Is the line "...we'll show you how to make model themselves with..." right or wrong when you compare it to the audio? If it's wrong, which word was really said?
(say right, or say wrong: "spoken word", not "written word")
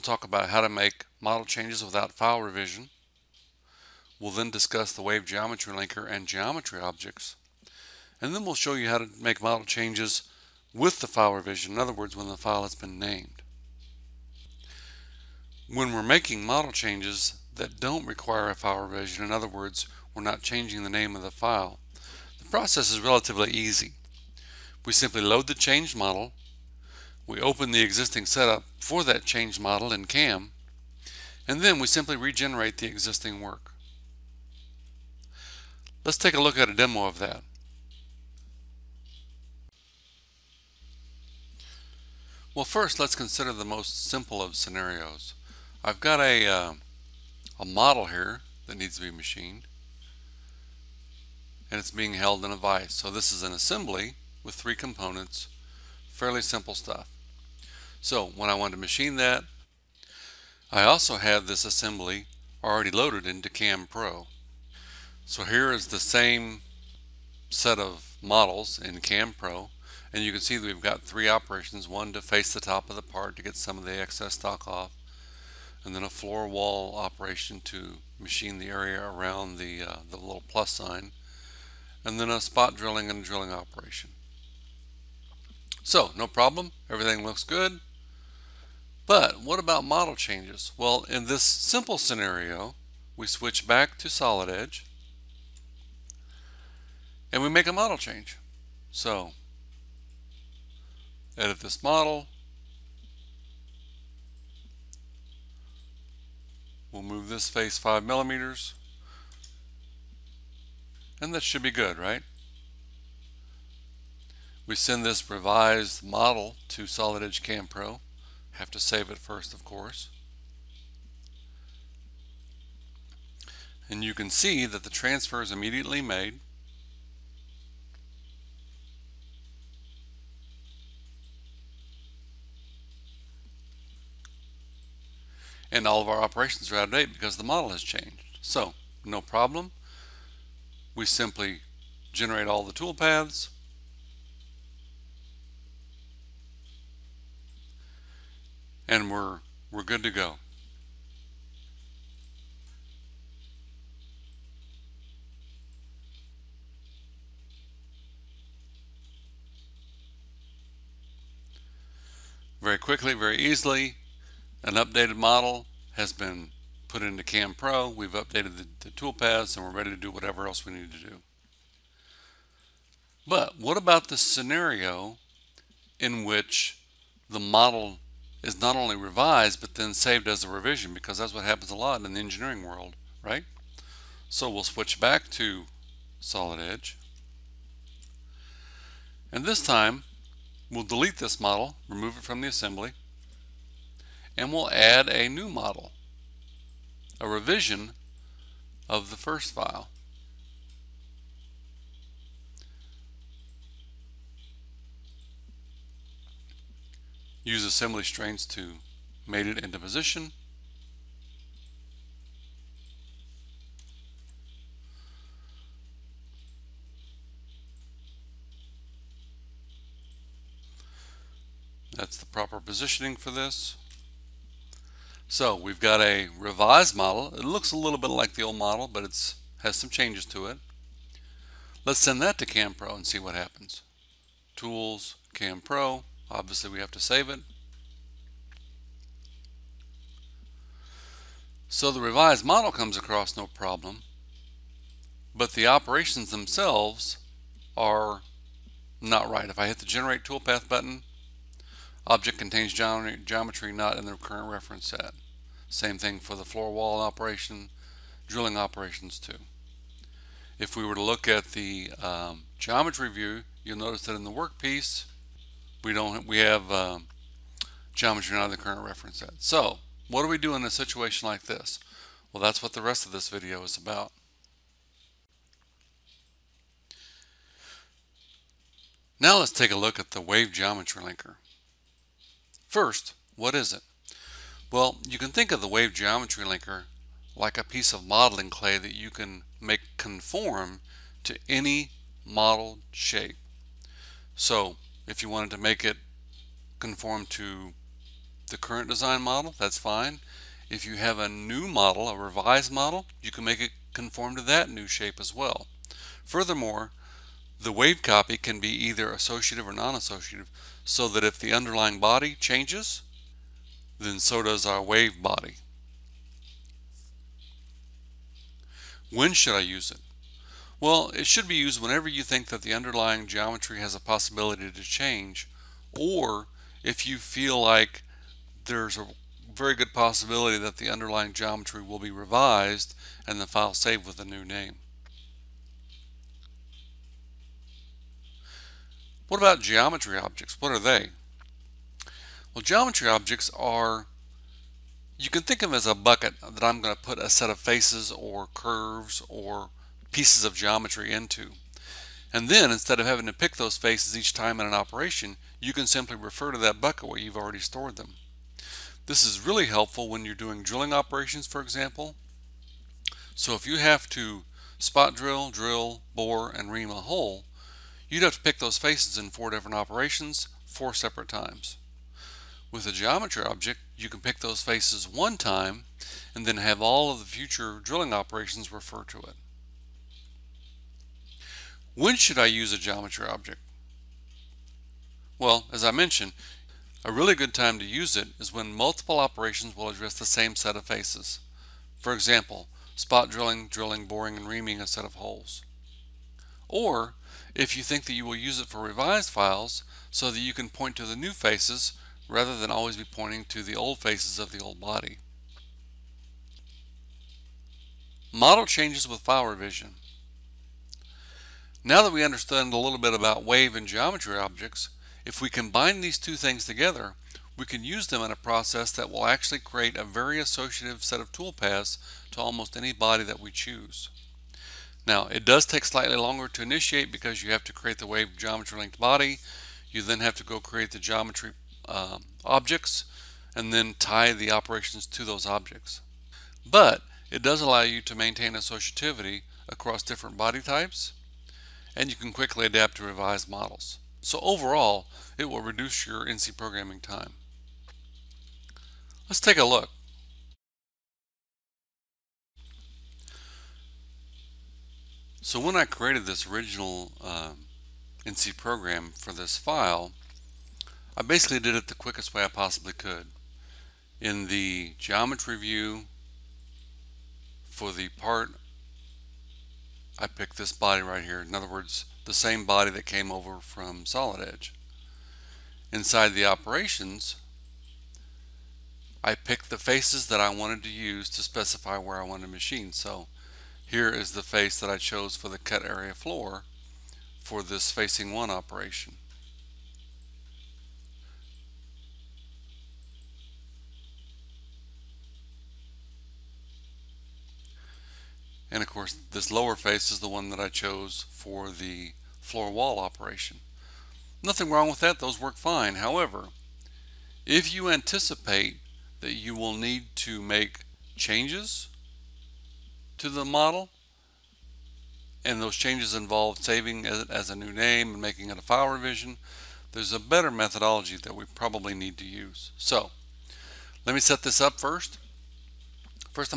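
wrong: "changes", not "themselves".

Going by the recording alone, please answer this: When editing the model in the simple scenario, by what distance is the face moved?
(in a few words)
5 millimeters.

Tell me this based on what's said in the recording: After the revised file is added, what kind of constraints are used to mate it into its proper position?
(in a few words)
Assembly constraints.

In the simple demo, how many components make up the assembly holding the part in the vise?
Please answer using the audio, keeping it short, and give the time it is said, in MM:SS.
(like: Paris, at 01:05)
3, at 00:54.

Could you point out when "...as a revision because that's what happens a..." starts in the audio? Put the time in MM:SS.
03:00.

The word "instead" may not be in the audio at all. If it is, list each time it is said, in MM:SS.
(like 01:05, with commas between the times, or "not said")
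05:52.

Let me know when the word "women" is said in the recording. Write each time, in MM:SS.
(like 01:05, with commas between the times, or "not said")
not said.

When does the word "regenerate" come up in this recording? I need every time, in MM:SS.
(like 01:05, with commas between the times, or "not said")
00:32.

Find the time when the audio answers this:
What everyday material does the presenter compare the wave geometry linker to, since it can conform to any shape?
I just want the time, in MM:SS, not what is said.
04:48.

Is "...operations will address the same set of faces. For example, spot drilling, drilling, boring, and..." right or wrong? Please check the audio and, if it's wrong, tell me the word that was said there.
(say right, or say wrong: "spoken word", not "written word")
right.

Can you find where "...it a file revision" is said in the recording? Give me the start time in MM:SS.
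08:38.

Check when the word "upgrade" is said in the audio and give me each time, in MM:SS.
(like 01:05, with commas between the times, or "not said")
not said.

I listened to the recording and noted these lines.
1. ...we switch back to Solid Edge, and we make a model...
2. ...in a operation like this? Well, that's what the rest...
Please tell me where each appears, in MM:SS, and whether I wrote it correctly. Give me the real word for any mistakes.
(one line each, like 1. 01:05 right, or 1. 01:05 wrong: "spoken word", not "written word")
1. 01:33 right
2. 04:30 wrong: "situation", not "operation".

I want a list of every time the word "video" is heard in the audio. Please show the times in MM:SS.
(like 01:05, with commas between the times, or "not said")
04:33.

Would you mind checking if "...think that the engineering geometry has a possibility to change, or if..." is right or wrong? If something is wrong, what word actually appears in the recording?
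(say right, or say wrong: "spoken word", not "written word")
wrong: "underlying", not "engineering".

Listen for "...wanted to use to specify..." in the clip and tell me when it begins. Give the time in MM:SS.
08:00.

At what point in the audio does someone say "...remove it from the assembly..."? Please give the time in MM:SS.
03:11.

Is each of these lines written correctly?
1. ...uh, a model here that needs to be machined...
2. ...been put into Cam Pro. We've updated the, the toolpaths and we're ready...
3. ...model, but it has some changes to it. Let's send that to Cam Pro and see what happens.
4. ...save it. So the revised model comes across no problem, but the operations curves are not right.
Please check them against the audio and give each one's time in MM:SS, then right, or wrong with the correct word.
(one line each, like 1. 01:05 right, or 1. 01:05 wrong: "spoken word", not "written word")
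1. 00:46 right
2. 02:46 right
3. 03:48 right
4. 03:57 wrong: "themselves", not "curves".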